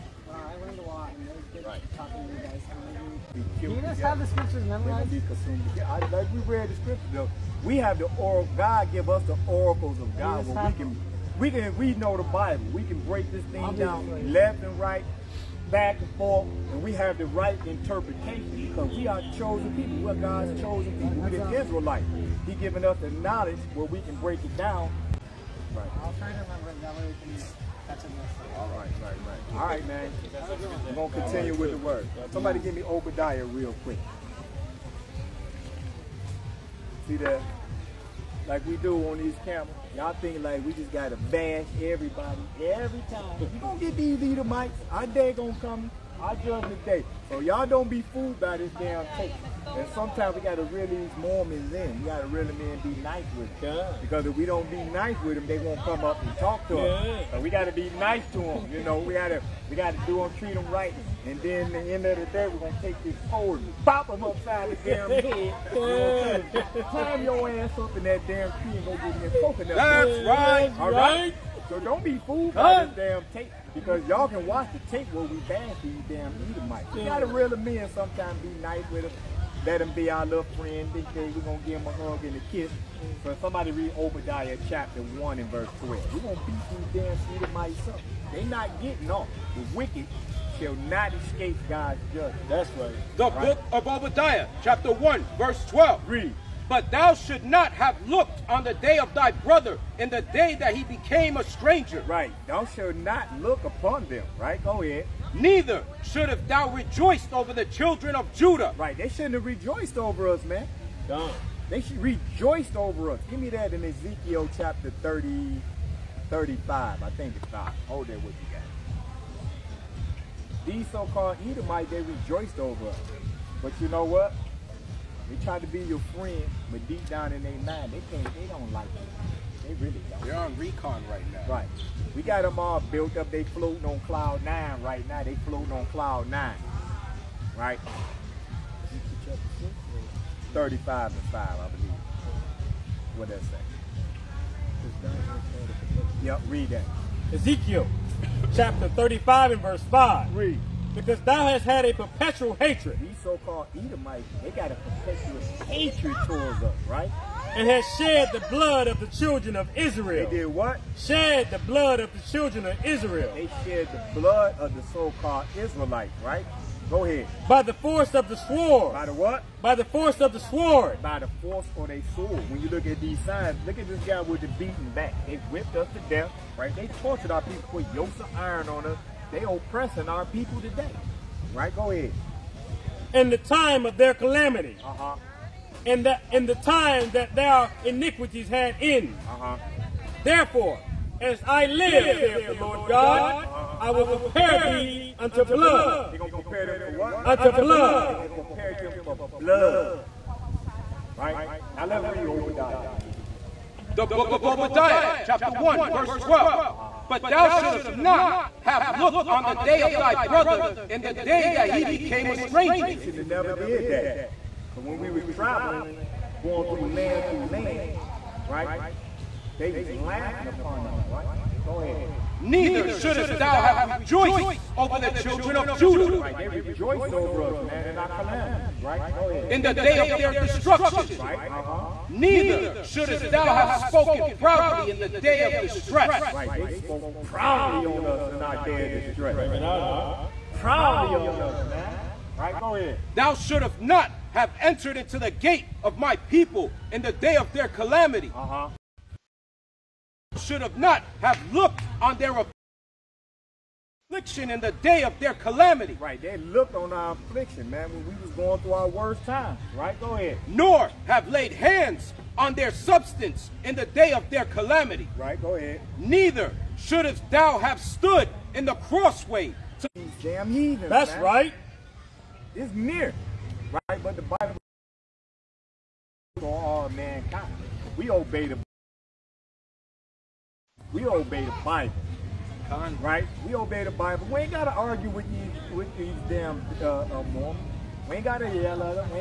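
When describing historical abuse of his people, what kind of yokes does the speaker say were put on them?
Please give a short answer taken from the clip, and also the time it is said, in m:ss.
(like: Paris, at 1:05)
yokes of iron, at 2:57.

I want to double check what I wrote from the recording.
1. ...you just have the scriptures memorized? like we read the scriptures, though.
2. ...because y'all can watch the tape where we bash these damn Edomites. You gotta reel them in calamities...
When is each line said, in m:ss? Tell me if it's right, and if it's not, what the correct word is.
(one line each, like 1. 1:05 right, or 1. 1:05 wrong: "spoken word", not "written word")
1. 0:03 right
2. 1:13 wrong: "sometimes", not "calamities".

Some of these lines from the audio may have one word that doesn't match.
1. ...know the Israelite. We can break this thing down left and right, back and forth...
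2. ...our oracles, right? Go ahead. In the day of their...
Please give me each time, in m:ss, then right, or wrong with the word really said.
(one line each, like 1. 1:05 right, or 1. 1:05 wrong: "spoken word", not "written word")
1. 0:11 wrong: "Bible", not "Israelite"
2. 3:47 wrong: "calamities", not "oracles".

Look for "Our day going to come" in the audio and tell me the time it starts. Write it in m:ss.
0:44.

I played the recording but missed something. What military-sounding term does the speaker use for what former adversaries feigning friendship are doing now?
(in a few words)
recon.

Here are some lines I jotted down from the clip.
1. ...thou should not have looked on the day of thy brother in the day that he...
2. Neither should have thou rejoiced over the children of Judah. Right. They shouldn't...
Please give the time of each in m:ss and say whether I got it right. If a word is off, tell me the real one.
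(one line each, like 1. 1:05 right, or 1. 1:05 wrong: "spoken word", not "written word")
1. 1:36 right
2. 1:45 right.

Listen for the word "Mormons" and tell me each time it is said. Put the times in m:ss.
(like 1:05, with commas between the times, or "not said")
0:51, 4:47.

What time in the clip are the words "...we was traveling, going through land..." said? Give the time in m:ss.
3:34.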